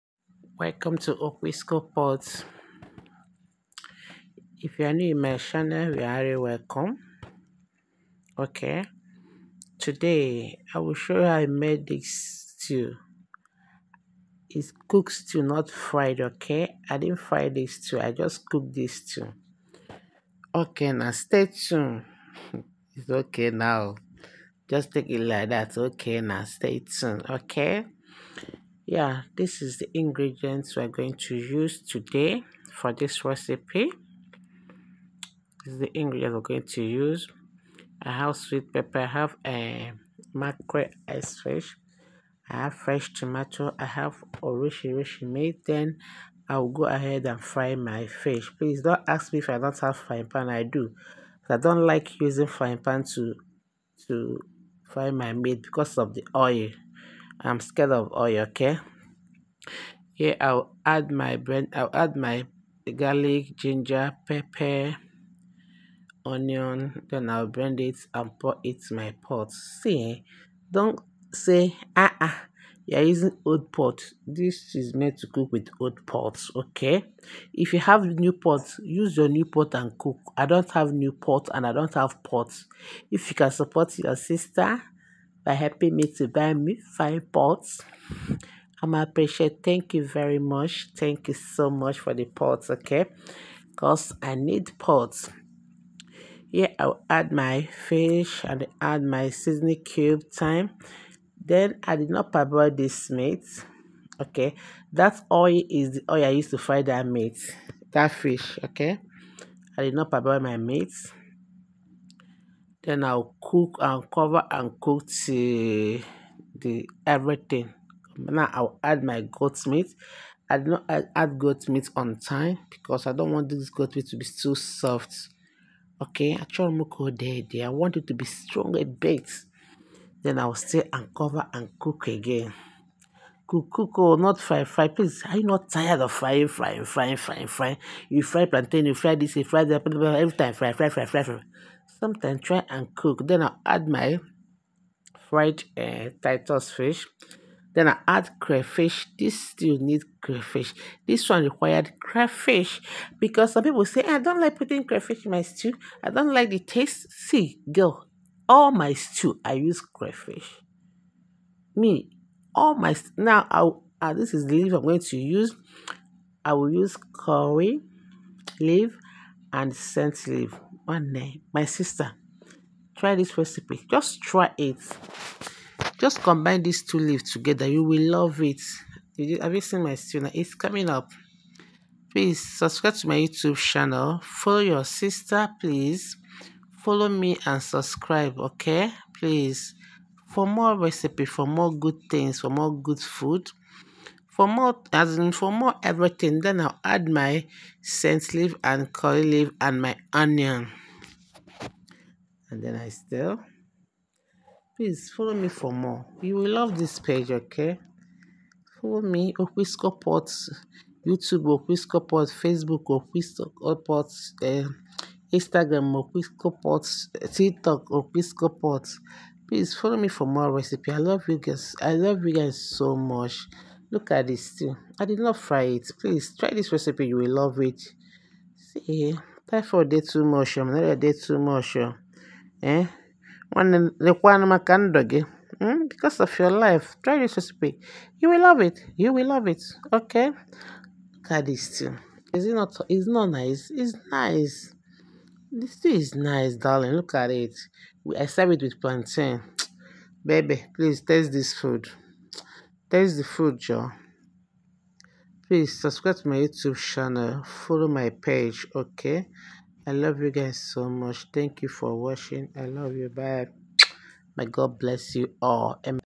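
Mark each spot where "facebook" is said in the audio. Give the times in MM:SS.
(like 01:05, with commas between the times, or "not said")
03:32.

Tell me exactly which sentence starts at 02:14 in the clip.
Please, are you not tired of frying, frying, frying, frying, frying?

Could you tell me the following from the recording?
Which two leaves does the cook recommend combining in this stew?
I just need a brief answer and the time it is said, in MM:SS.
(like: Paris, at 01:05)
Curry leaf and scent leaf, at 02:47.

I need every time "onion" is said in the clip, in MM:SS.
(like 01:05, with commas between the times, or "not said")
01:06, 03:20.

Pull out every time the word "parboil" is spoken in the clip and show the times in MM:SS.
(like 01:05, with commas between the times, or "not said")
01:42, 01:50.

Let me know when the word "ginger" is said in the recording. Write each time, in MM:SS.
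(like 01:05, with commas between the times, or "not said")
01:03.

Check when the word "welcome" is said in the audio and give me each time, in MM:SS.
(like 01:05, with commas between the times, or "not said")
00:00, 00:06.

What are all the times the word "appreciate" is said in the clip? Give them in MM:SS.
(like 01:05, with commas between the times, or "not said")
01:28.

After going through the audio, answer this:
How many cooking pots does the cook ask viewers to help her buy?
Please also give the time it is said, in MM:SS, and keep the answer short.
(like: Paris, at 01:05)
5, at 01:26.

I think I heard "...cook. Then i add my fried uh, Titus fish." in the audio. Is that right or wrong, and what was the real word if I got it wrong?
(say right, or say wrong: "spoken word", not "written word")
right.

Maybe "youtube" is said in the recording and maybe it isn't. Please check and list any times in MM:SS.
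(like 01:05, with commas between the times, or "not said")
03:03, 03:31, 04:16.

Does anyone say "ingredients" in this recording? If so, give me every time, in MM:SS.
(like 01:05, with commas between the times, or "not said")
00:29, 00:35.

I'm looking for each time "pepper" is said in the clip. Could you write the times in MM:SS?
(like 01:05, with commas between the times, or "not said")
00:38, 01:04.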